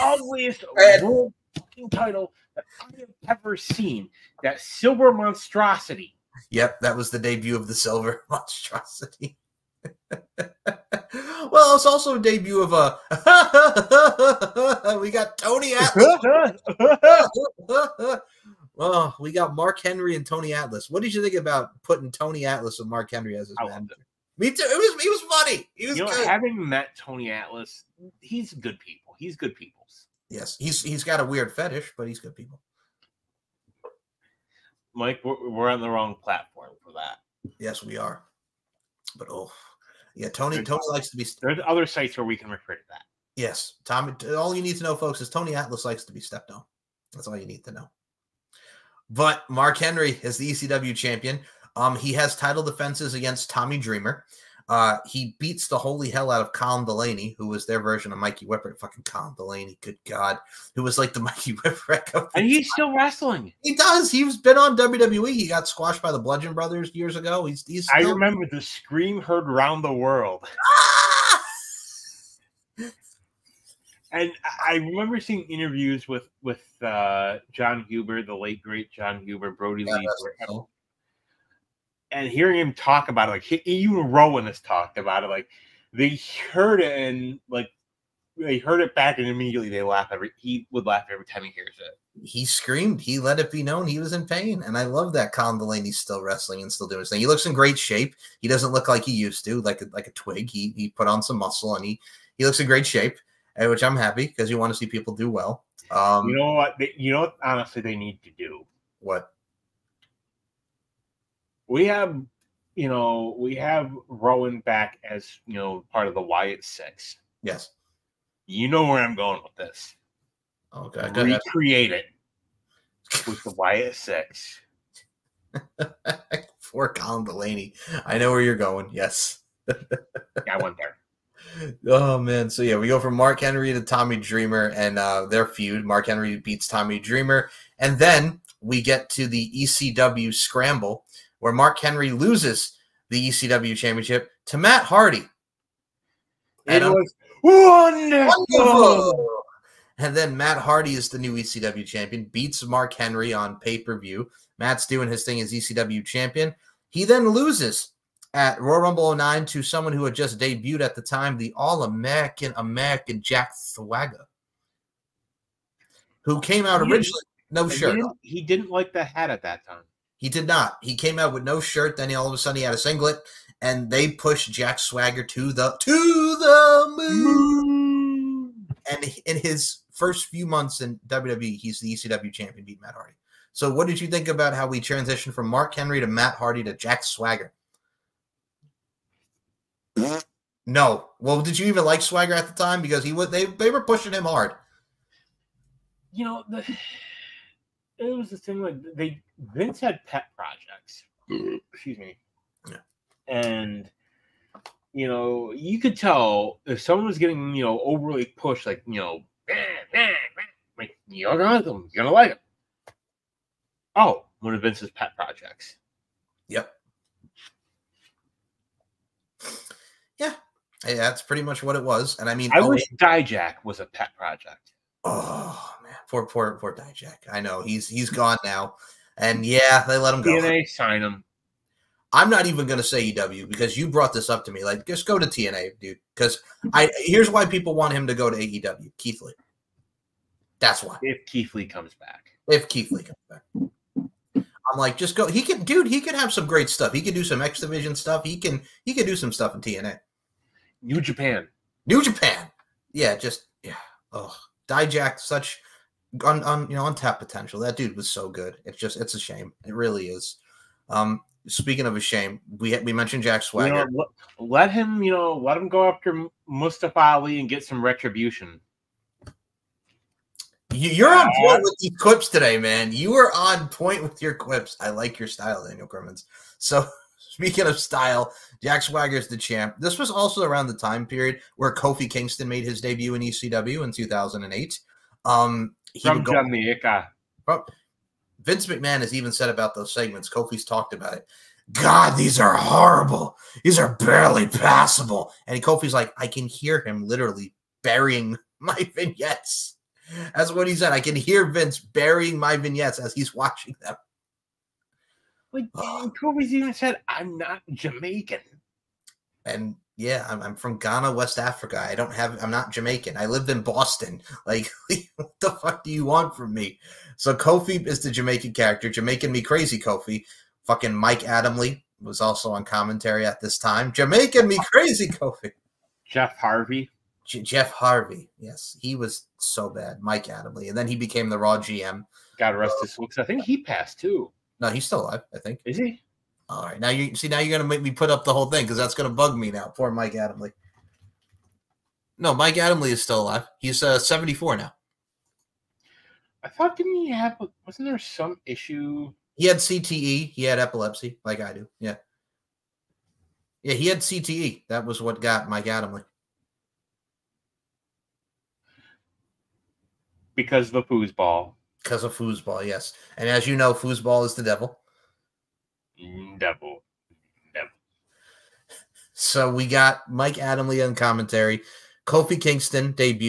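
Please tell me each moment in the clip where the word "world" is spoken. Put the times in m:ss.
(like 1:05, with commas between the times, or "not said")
0:01, 1:09.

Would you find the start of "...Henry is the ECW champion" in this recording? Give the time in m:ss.
0:49.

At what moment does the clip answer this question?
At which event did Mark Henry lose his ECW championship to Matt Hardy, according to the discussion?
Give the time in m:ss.
2:19.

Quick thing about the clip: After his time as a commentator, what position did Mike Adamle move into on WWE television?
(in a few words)
Raw GM.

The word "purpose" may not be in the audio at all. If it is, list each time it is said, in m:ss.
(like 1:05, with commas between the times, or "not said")
not said.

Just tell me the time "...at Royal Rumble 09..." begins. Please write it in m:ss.
2:38.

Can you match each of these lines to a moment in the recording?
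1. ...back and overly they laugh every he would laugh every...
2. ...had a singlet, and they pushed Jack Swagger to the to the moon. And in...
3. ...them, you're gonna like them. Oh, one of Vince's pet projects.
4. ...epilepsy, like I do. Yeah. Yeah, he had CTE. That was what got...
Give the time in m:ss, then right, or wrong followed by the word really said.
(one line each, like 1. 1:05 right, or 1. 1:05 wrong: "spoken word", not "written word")
1. 1:28 wrong: "immediately", not "overly"
2. 2:52 right
3. 3:31 right
4. 5:50 right.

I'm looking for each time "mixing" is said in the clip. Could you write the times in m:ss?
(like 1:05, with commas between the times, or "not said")
not said.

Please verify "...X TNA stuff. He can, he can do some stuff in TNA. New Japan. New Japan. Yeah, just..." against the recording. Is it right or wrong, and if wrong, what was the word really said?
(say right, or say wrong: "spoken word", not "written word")
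wrong: "Division", not "TNA".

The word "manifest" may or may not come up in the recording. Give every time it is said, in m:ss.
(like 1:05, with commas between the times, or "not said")
not said.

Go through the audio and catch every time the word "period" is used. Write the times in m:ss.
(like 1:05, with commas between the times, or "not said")
4:41.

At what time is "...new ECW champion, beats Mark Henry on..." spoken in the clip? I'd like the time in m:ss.
2:31.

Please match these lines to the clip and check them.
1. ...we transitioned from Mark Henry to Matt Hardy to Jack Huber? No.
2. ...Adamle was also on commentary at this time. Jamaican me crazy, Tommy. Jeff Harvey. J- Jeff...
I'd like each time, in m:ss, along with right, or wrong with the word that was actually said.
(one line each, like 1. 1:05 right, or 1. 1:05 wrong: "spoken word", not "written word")
1. 3:04 wrong: "Swagger", not "Huber"
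2. 5:21 wrong: "Kofi", not "Tommy".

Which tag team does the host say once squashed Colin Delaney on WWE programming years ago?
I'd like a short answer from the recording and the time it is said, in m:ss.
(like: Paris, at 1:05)
The Bludgeon Brothers, at 1:06.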